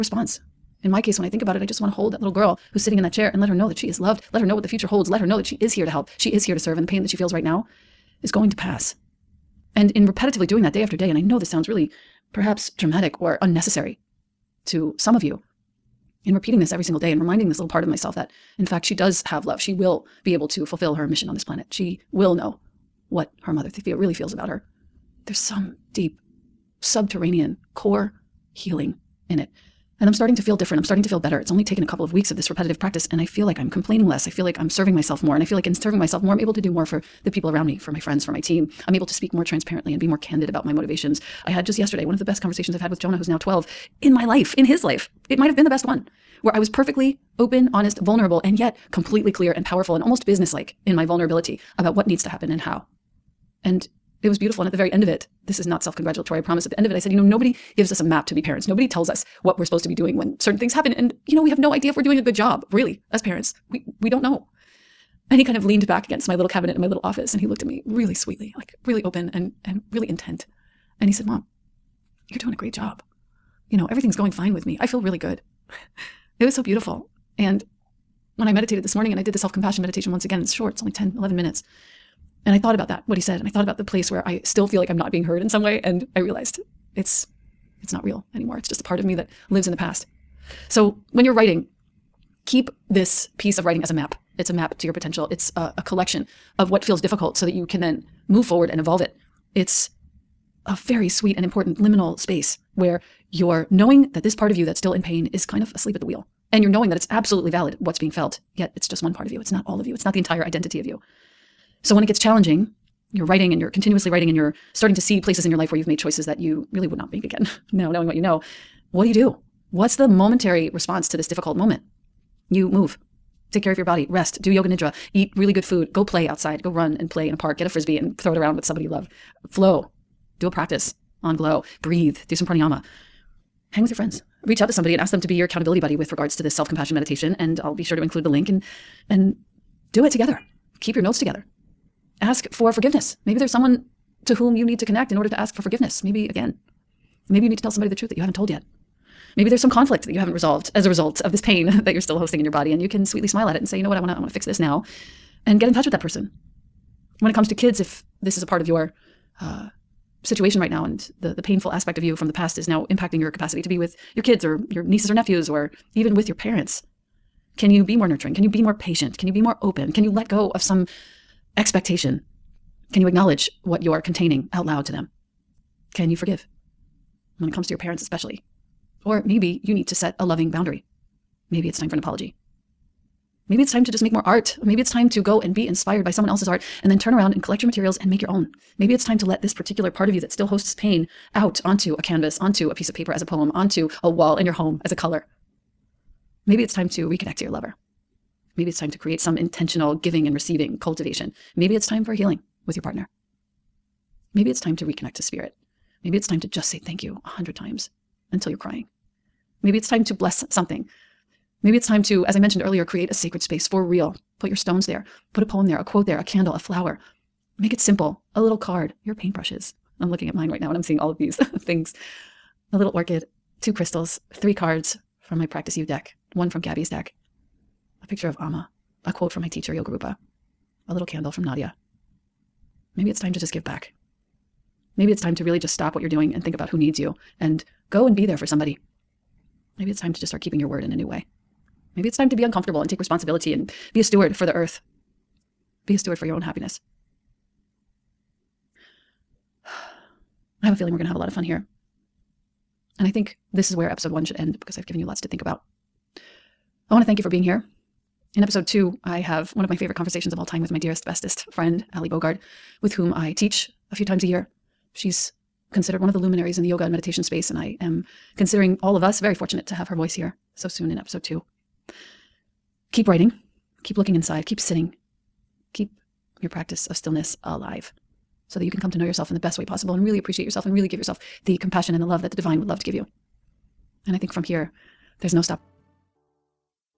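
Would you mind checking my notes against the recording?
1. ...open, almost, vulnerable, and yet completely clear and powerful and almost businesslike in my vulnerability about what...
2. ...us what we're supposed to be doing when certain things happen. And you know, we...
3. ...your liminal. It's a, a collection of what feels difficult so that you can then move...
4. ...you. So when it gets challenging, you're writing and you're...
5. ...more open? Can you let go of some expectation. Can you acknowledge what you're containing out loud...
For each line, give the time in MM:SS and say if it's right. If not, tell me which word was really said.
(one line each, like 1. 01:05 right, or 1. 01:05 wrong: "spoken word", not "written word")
1. 00:47 wrong: "honest", not "almost"
2. 00:59 right
3. 01:34 wrong: "potential", not "liminal"
4. 01:50 right
5. 02:49 right.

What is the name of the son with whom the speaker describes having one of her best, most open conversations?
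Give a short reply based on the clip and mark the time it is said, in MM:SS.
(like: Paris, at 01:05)
Jonah, at 00:42.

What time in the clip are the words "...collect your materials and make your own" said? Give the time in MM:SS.
03:07.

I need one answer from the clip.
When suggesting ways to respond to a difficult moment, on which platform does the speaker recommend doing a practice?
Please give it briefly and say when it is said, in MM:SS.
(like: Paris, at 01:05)
Glo, at 02:11.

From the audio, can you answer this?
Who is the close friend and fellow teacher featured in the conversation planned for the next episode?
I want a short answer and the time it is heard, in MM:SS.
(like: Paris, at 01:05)
Ali Bogard, at 04:21.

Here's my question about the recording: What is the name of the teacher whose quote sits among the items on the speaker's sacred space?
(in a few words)
Yogarupa.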